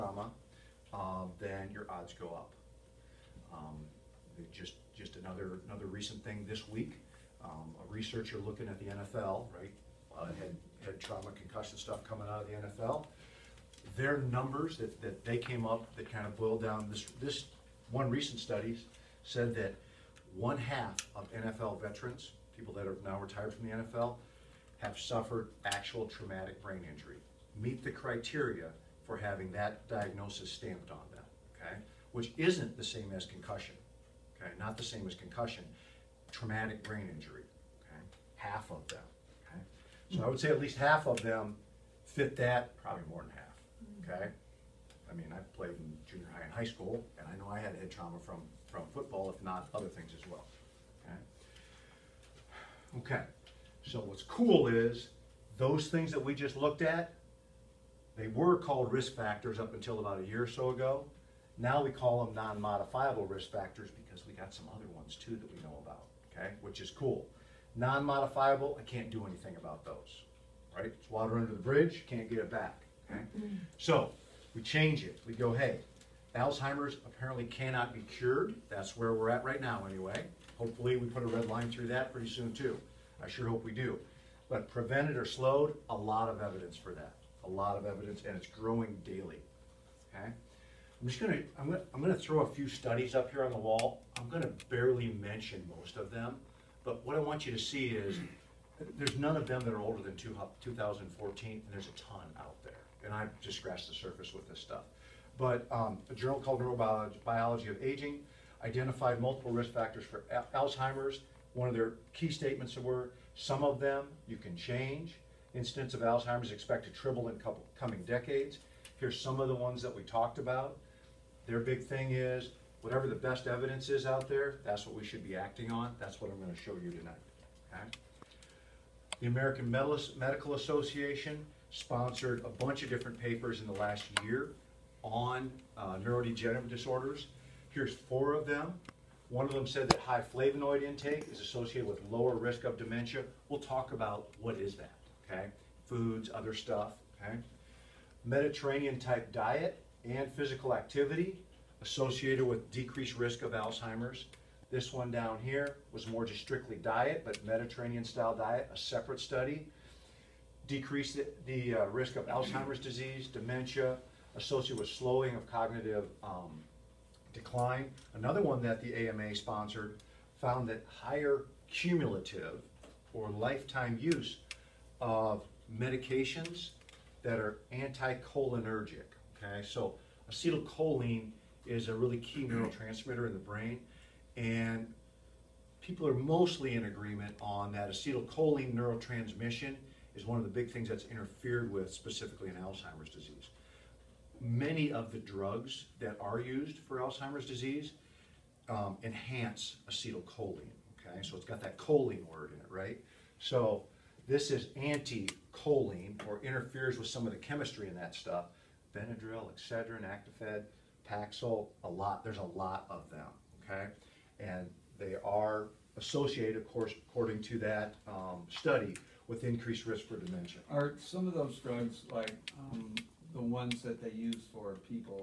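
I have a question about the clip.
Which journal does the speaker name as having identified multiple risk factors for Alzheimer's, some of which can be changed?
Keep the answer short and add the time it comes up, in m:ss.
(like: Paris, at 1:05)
Neurobiology of Aging, at 1:46.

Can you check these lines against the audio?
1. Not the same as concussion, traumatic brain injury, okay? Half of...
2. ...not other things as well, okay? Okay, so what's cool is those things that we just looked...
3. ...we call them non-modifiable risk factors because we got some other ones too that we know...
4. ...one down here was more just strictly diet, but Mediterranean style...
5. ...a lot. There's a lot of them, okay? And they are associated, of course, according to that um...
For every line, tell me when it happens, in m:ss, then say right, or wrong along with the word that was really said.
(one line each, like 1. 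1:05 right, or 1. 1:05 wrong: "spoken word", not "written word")
1. 0:34 right
2. 0:49 right
3. 1:01 right
4. 2:34 right
5. 3:31 right.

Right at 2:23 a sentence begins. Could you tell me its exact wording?
We'll talk about what is that okay?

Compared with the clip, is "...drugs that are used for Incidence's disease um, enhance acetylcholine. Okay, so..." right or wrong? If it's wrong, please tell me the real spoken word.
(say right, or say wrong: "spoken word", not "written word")
wrong: "Alzheimer", not "Incidence".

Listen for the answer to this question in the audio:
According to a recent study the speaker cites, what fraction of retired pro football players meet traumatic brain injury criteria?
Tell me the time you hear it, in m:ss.
0:20.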